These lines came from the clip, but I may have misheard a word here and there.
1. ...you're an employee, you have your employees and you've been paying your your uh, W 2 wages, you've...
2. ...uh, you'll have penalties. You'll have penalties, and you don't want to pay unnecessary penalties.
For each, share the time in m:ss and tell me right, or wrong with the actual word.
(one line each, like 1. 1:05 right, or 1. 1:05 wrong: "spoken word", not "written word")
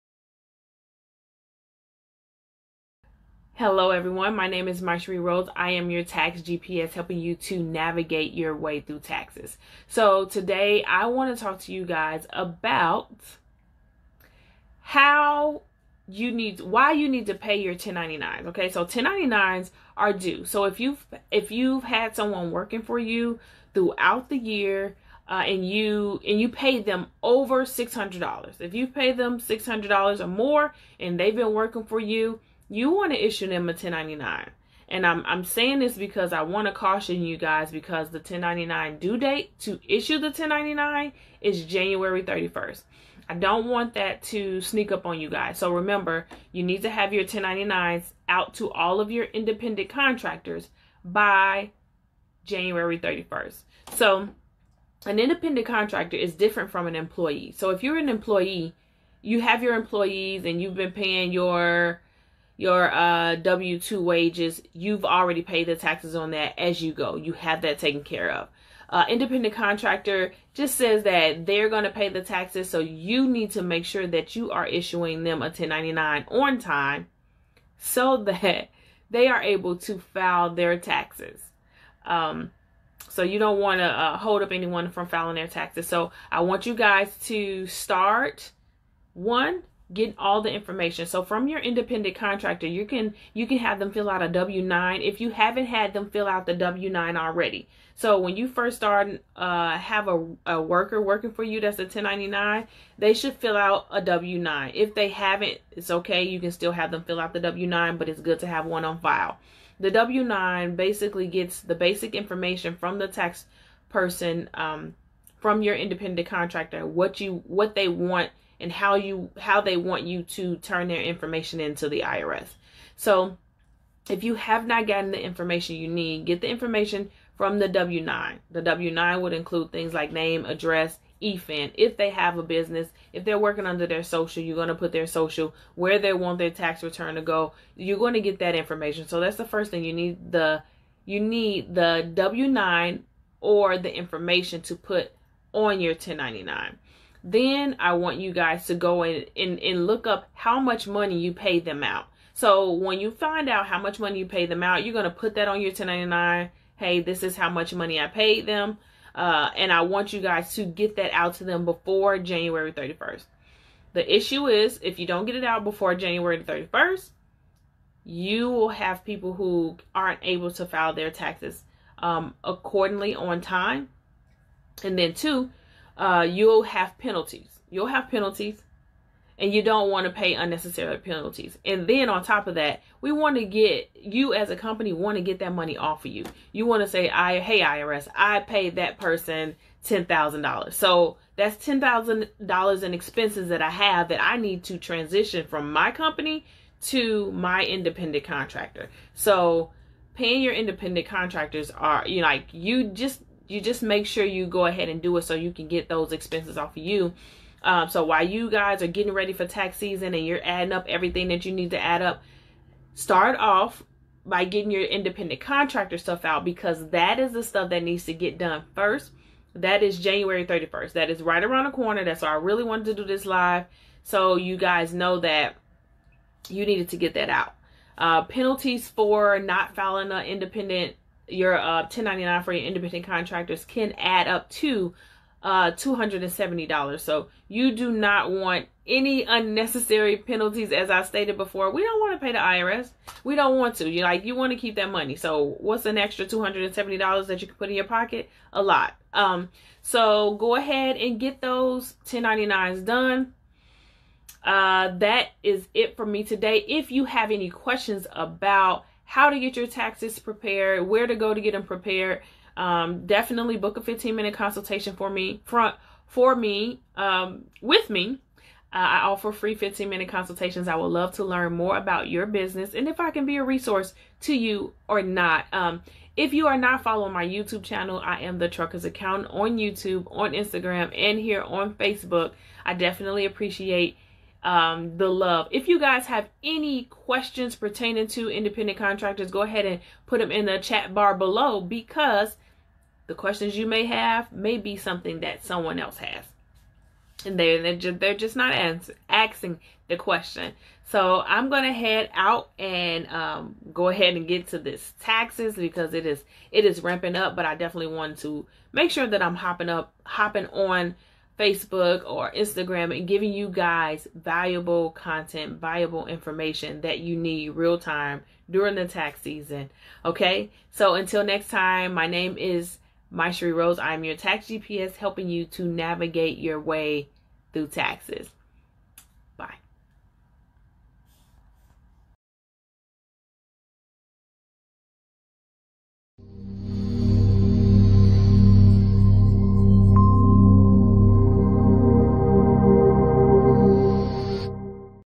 1. 0:57 right
2. 2:55 right.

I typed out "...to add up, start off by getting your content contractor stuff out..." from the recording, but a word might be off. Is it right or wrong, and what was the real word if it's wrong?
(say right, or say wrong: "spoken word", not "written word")
wrong: "independent", not "content".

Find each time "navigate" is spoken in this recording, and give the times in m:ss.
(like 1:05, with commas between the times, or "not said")
0:07, 5:25.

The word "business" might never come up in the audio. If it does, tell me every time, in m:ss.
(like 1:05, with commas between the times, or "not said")
2:12, 4:32.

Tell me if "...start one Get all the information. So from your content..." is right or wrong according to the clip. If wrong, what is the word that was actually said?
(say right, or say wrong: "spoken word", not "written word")
wrong: "independent", not "content".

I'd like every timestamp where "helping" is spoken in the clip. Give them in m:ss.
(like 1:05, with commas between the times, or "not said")
0:06, 5:24.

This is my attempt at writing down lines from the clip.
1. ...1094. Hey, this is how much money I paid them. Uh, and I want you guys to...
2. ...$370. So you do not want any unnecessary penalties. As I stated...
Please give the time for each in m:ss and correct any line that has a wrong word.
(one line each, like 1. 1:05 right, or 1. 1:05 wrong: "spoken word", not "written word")
1. 2:35 wrong: "1099", not "1094"
2. 3:55 wrong: "270", not "370".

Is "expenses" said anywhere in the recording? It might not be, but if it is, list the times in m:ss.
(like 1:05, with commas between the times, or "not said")
3:12, 3:26.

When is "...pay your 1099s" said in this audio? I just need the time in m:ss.
0:17.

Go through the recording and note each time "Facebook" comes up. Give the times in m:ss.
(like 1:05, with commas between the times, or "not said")
4:41, 5:11.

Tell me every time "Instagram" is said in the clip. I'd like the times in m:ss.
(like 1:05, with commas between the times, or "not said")
4:40, 5:12.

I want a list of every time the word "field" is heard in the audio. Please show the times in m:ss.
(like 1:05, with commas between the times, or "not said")
not said.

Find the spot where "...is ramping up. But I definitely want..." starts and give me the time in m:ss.
5:06.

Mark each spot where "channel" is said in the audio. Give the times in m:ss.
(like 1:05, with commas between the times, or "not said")
4:37.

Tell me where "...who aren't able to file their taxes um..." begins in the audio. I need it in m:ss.
2:49.